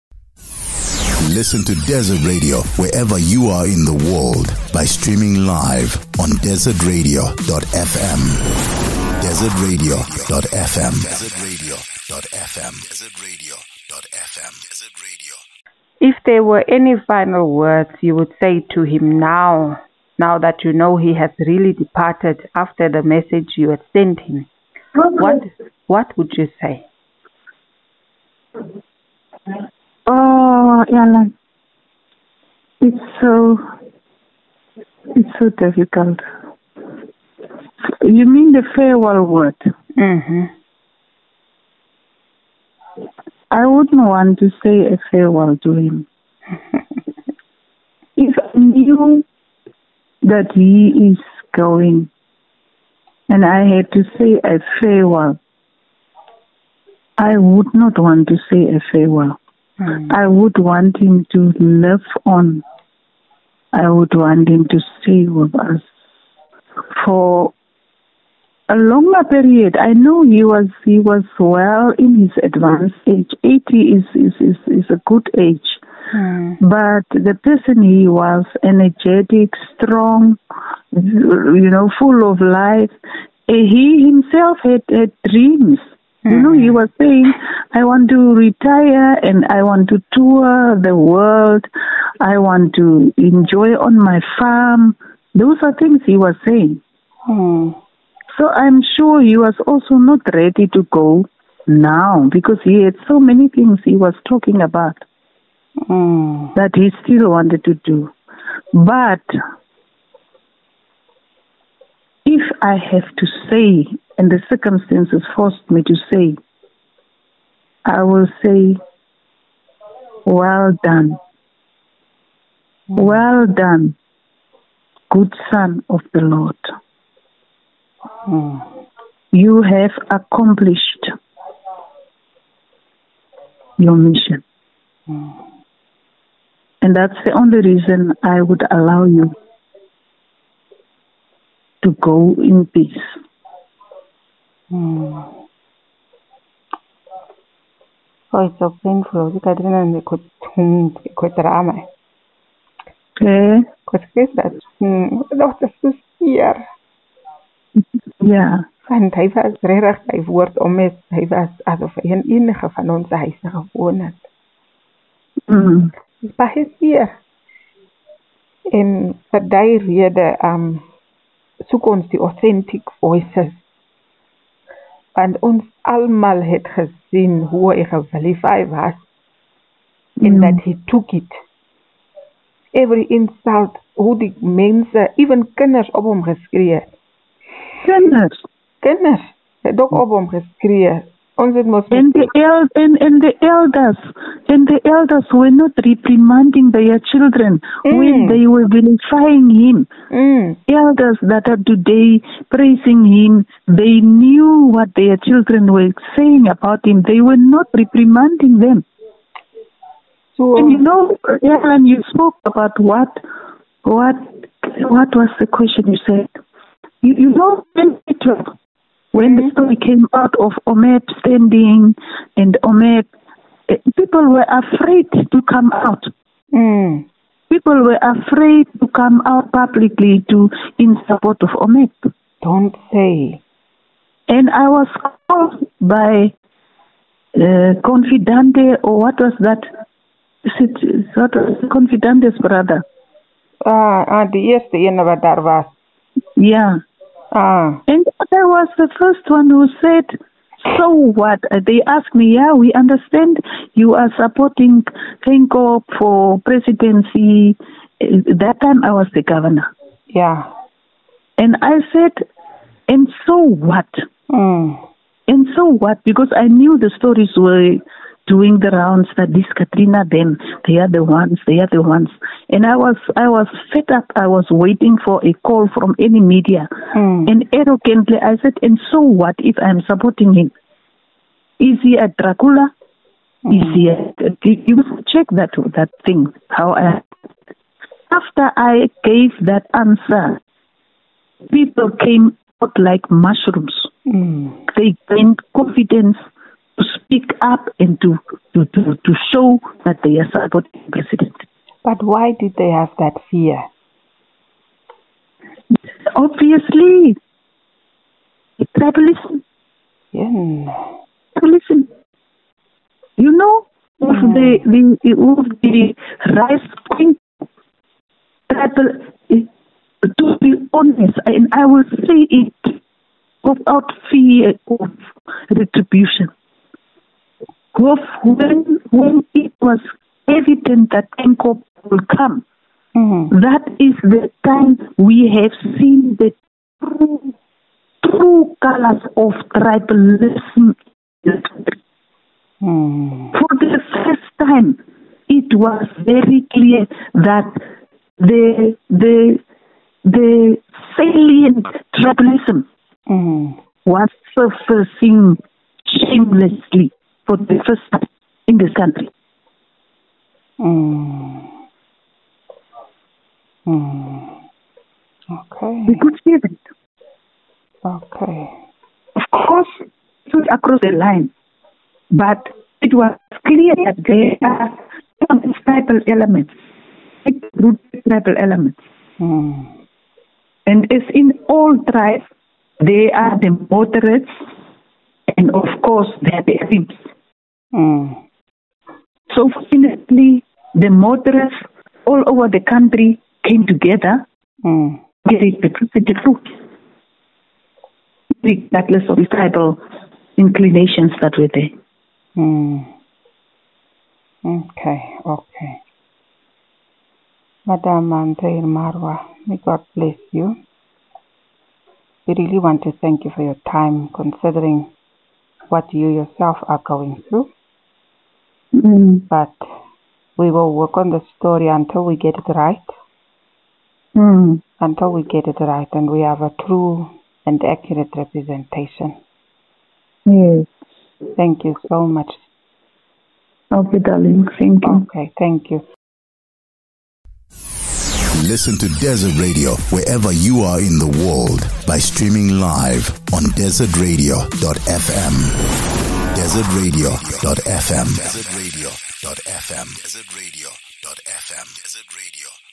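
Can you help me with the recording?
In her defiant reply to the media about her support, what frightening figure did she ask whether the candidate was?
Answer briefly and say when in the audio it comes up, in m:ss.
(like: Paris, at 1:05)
Dracula, at 4:42.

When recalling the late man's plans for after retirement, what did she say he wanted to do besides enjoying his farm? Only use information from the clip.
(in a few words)
tour the world.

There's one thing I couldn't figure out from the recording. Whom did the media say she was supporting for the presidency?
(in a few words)
Geingob.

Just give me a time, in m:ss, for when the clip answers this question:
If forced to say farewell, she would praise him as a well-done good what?
2:05.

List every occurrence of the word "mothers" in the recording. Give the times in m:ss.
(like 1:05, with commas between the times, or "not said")
6:30.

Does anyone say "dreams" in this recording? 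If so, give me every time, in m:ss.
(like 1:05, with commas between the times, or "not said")
1:25.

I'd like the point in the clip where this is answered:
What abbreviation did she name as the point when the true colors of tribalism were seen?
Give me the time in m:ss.
5:31.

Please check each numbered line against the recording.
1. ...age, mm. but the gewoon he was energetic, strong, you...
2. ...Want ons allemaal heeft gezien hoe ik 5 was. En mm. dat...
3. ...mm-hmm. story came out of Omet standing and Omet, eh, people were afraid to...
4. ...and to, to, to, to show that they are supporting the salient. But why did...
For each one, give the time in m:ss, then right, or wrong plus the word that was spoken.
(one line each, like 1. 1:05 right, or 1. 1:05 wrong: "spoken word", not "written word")
1. 1:15 wrong: "person", not "gewoon"
2. 2:55 right
3. 3:39 right
4. 4:57 wrong: "president", not "salient".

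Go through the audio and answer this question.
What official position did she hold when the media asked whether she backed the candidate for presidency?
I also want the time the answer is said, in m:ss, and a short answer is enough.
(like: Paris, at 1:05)
governor, at 4:19.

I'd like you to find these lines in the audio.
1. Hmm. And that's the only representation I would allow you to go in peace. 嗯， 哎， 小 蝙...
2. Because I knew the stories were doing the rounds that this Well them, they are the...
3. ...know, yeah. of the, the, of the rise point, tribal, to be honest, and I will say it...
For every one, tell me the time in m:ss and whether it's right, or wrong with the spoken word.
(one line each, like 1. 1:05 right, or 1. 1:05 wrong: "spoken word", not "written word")
1. 2:15 wrong: "reason", not "representation"
2. 4:26 wrong: "Katrina", not "Well"
3. 5:13 right.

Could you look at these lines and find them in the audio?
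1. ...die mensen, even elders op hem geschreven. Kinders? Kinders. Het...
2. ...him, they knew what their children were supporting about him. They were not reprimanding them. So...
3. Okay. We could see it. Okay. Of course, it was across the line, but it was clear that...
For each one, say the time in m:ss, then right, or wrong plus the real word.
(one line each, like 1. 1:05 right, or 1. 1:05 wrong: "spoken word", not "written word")
1. 3:04 wrong: "kinders", not "elders"
2. 3:23 wrong: "saying", not "supporting"
3. 6:05 right.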